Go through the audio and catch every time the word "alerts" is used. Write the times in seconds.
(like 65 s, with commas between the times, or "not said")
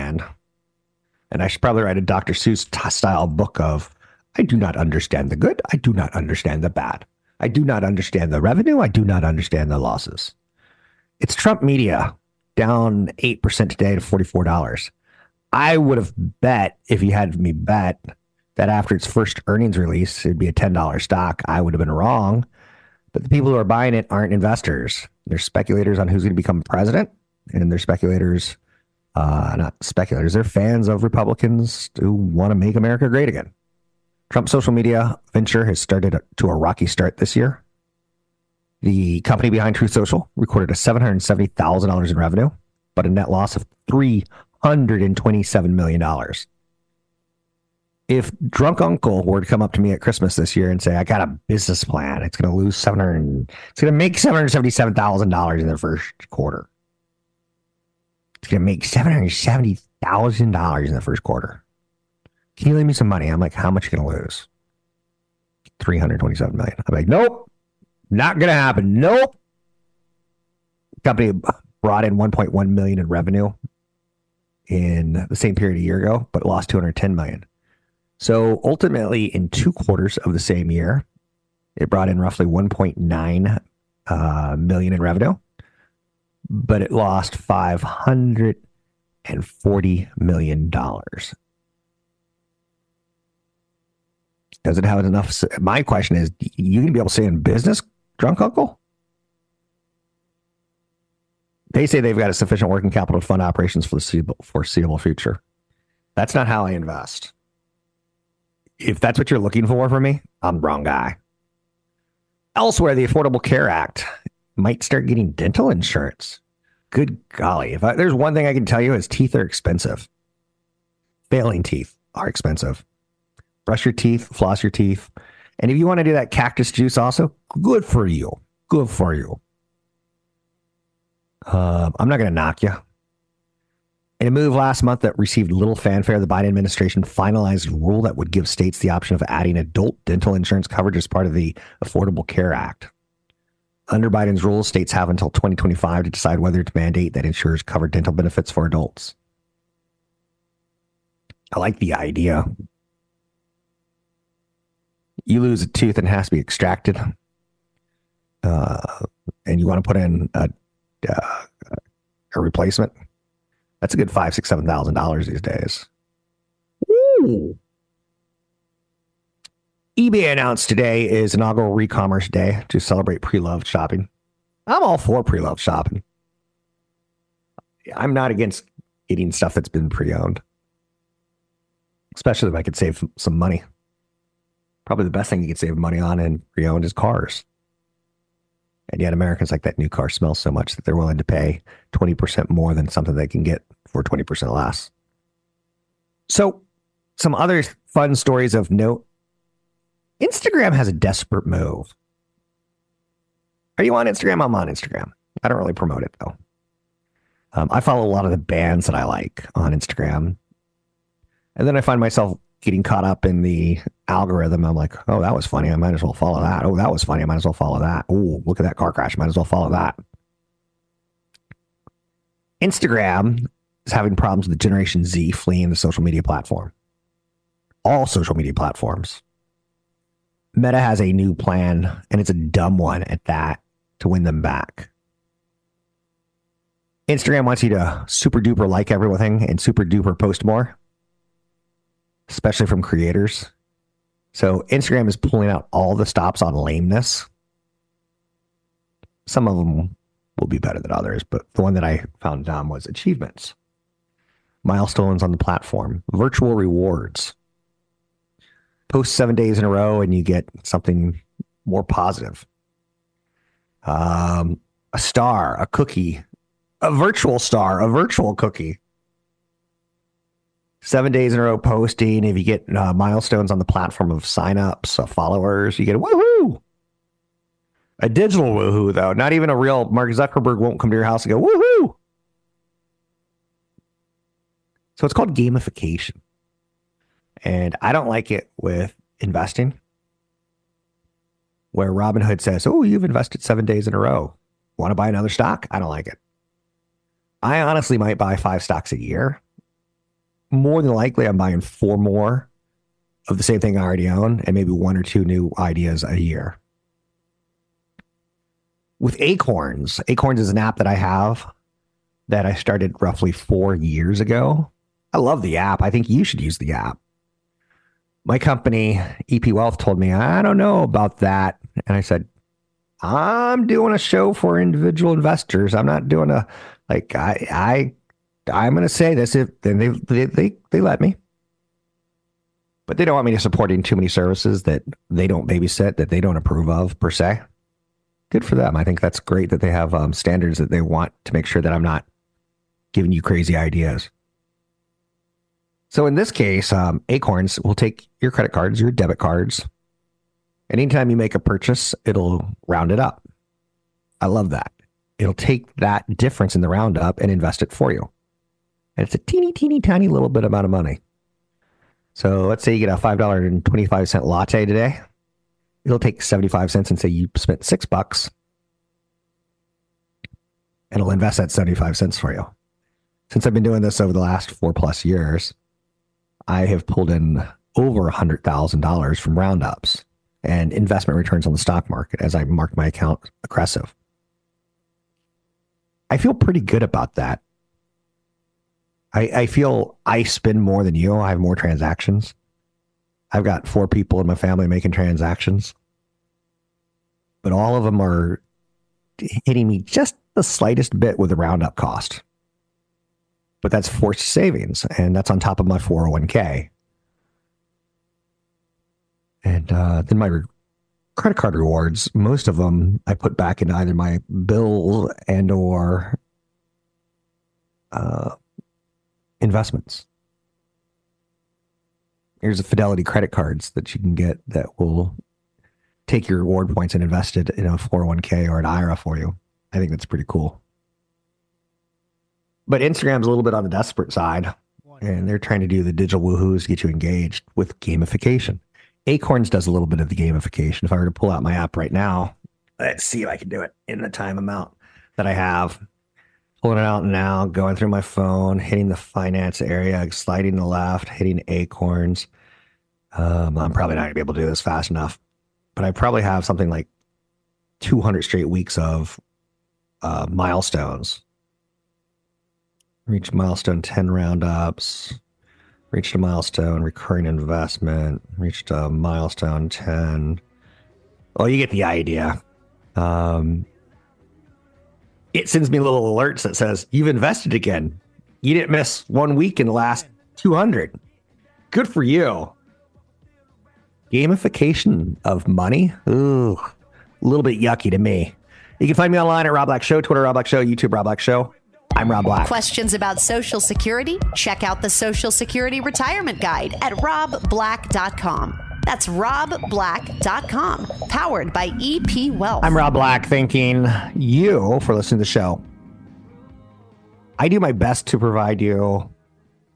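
476 s.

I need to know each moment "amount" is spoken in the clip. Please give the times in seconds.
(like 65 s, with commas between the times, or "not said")
360 s, 444 s.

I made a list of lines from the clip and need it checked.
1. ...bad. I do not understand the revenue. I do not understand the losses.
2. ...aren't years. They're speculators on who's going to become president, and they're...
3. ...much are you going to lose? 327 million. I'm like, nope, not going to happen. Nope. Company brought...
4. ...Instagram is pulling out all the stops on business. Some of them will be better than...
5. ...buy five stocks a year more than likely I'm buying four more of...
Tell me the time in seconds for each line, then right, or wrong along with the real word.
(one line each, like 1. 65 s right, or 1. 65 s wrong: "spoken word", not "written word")
1. 6 s right
2. 24 s wrong: "investors", not "years"
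3. 63 s right
4. 244 s wrong: "lameness", not "business"
5. 298 s right.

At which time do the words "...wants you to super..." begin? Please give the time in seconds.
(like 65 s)
237 s.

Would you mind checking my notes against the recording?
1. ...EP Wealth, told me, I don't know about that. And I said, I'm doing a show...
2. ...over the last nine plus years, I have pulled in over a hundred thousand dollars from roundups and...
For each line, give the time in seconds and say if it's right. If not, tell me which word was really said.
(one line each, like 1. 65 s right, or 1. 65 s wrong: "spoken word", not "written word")
1. 319 s right
2. 374 s wrong: "four", not "nine".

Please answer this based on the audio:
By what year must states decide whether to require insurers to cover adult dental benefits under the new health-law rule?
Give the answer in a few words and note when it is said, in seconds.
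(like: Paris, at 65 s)
2025, at 145 s.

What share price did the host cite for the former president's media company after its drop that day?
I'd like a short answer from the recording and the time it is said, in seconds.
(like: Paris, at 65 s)
$44, at 14 s.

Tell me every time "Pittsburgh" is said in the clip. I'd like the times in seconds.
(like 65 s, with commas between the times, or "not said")
not said.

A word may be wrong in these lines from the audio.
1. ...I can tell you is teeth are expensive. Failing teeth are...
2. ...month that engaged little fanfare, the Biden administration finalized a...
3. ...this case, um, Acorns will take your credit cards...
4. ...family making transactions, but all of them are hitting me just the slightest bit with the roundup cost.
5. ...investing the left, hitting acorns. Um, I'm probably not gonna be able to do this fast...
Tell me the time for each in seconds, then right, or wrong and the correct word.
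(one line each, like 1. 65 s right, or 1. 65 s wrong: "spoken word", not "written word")
1. 118 s right
2. 134 s wrong: "received", not "engaged"
3. 346 s right
4. 394 s right
5. 450 s wrong: "sliding", not "investing".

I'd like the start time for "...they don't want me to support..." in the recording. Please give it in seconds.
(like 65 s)
332 s.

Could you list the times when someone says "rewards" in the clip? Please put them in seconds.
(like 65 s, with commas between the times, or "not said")
256 s, 411 s, 426 s.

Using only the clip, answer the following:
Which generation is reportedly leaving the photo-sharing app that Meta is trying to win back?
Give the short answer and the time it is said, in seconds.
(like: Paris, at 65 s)
Generation Z, at 224 s.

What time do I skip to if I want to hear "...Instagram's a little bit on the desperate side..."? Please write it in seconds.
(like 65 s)
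432 s.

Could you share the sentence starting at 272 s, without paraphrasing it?
If you get uh, milestones on the platform of signups, uh, followers, you get a woohoo.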